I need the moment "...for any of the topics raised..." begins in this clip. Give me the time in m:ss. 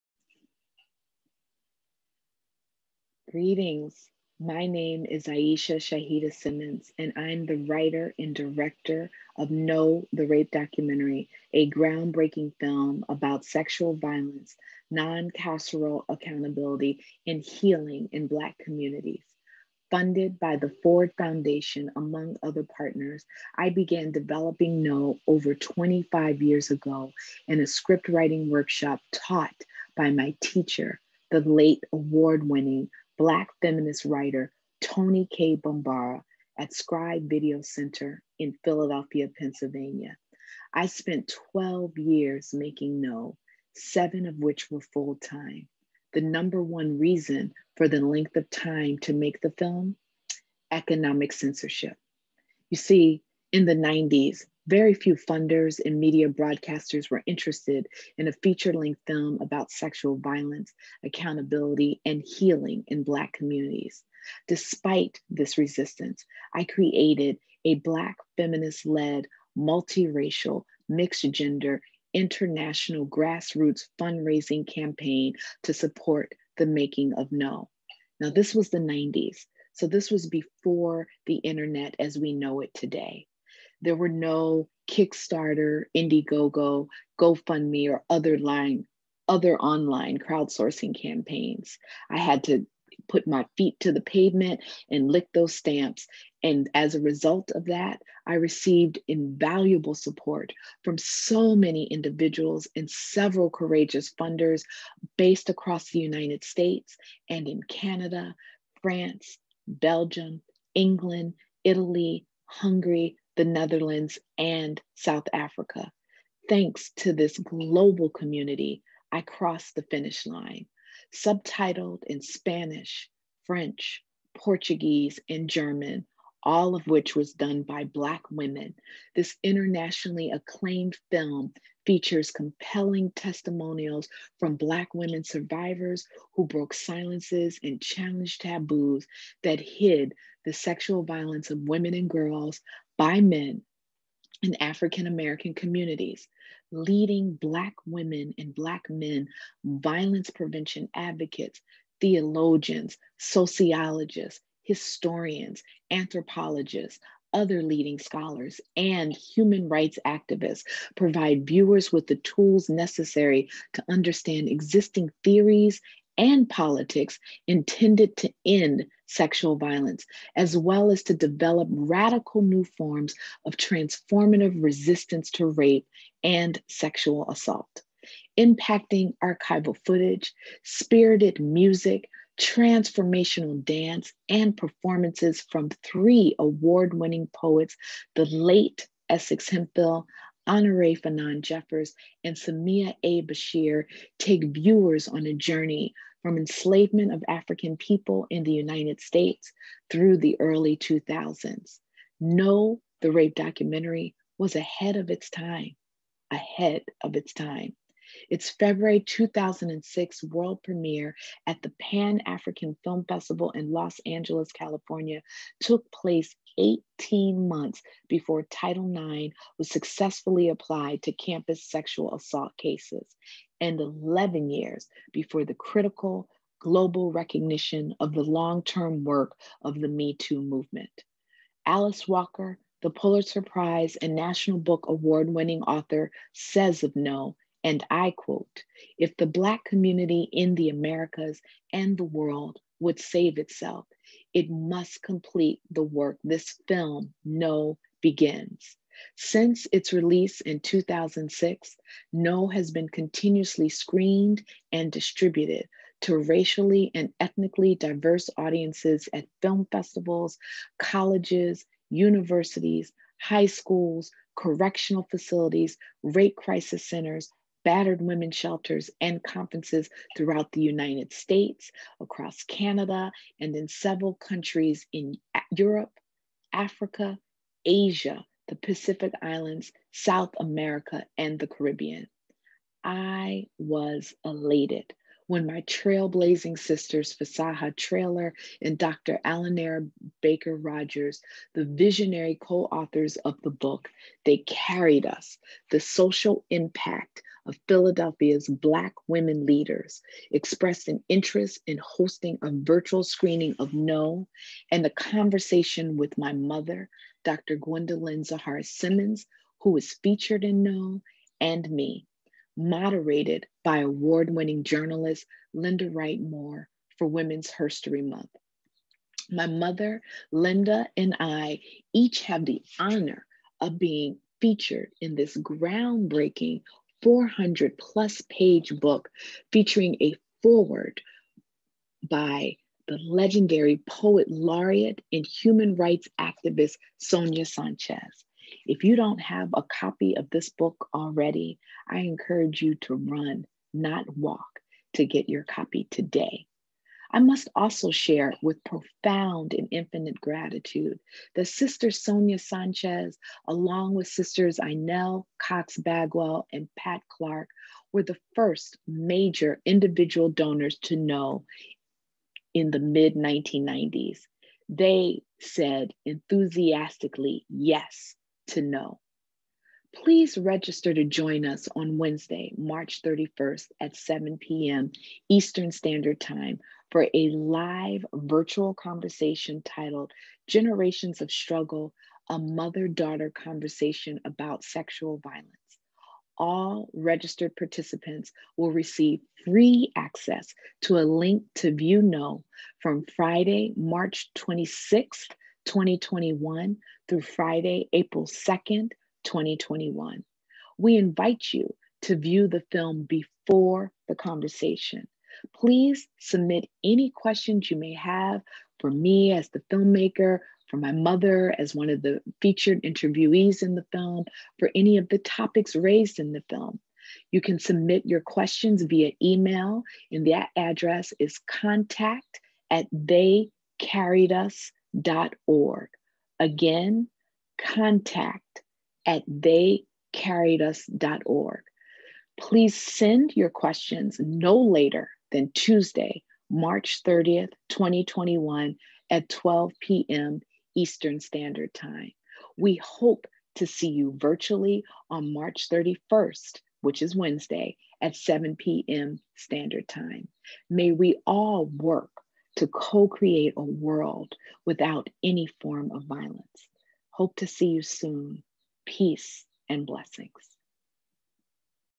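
6:54.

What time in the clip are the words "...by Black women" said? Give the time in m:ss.
2:07.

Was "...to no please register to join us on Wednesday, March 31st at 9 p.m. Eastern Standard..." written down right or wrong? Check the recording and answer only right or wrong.
wrong.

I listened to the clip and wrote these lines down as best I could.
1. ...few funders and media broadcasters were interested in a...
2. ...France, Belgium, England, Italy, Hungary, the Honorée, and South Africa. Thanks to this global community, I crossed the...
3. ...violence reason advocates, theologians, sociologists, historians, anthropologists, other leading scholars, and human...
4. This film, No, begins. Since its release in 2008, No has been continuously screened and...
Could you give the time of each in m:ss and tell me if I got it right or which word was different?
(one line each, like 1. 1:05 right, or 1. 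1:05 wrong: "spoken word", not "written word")
1. 0:54 right
2. 1:48 wrong: "Netherlands", not "Honorée"
3. 2:29 wrong: "prevention", not "reason"
4. 4:06 wrong: "2006", not "2008".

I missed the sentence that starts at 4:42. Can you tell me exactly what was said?
I was elated when my trailblazing sisters, Fasaha Traylor and Dr.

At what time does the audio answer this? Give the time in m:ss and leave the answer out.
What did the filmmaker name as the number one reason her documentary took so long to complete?
0:50.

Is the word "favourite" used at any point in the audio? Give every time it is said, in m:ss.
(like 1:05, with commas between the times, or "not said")
not said.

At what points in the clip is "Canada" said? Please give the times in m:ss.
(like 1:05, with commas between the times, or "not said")
1:47, 4:32.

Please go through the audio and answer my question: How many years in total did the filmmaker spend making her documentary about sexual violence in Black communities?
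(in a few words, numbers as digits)
12.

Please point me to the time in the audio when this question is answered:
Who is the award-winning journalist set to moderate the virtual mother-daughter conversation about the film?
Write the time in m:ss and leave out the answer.
5:15.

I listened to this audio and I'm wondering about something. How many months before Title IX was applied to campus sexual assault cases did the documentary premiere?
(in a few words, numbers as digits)
18.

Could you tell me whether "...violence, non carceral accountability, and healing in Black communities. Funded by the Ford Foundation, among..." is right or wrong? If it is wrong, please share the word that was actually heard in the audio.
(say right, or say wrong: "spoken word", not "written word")
right.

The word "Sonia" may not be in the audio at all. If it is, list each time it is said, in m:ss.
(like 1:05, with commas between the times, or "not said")
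5:36, 5:51.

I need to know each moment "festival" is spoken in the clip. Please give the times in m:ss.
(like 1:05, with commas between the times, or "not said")
3:33, 4:19.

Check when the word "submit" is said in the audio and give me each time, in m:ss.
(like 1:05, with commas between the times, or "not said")
6:46, 6:57.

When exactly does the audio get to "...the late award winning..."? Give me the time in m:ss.
0:31.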